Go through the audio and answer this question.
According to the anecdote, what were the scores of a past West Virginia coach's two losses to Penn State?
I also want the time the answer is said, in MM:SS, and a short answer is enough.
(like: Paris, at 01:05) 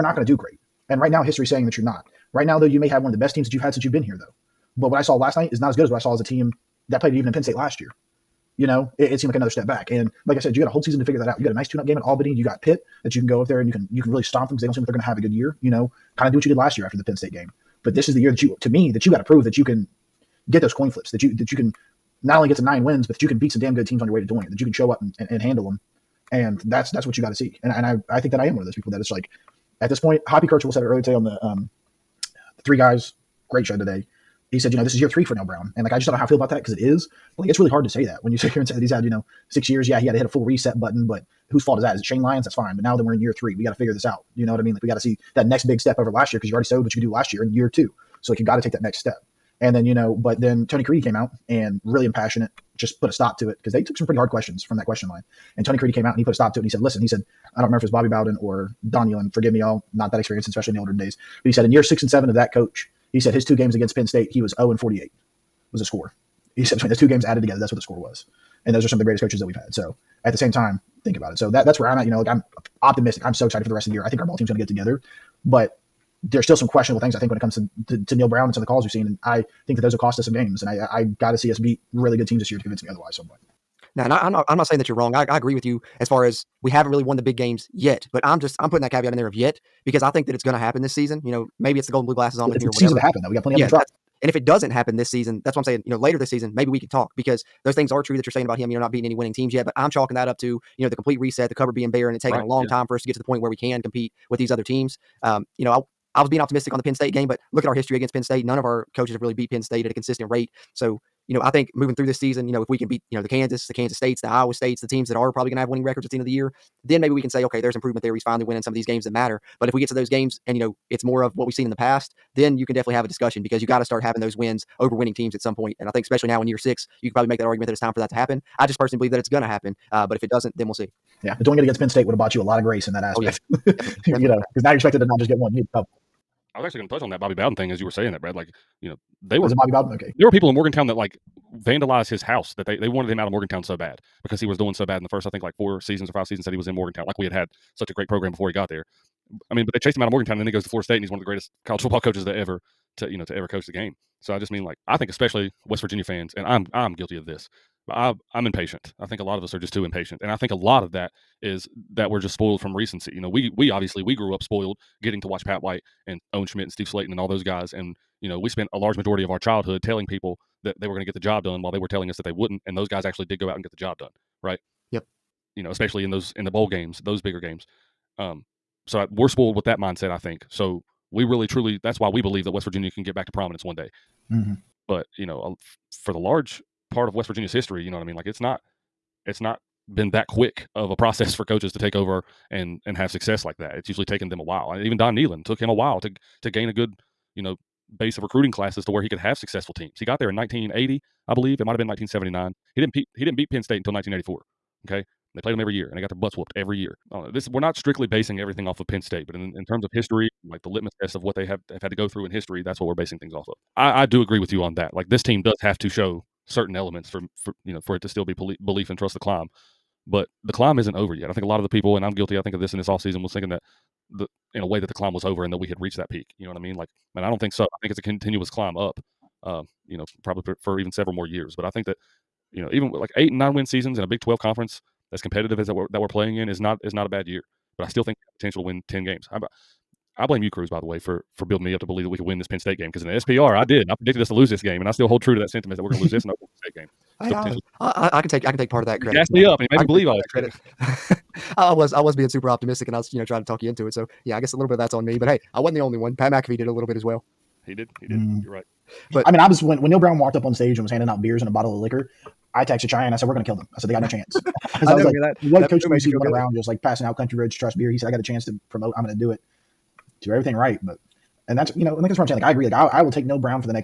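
0 and 48, at 01:04.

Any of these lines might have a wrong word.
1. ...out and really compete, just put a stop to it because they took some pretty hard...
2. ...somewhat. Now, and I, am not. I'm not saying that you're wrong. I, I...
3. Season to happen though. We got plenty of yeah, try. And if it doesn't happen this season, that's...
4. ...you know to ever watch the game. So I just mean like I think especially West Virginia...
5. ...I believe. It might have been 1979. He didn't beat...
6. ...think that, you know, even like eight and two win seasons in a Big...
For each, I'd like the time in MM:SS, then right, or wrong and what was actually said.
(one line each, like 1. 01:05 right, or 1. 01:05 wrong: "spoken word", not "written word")
1. 00:51 wrong: "impassionate", not "compete"
2. 01:23 right
3. 01:32 right
4. 02:33 wrong: "coach", not "watch"
5. 03:21 right
6. 03:51 wrong: "nine", not "two".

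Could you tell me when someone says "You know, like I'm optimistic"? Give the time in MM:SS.
01:12.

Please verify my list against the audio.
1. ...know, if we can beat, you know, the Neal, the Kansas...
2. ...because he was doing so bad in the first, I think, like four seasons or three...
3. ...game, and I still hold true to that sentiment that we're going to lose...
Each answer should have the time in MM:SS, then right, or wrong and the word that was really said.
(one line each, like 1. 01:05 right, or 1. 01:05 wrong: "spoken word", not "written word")
1. 01:52 wrong: "Kansas", not "Neal"
2. 02:24 wrong: "five", not "three"
3. 04:04 right.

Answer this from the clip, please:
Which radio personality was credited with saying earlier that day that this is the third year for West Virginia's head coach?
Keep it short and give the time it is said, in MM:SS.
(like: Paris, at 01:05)
Hoppy Kercheval, at 00:30.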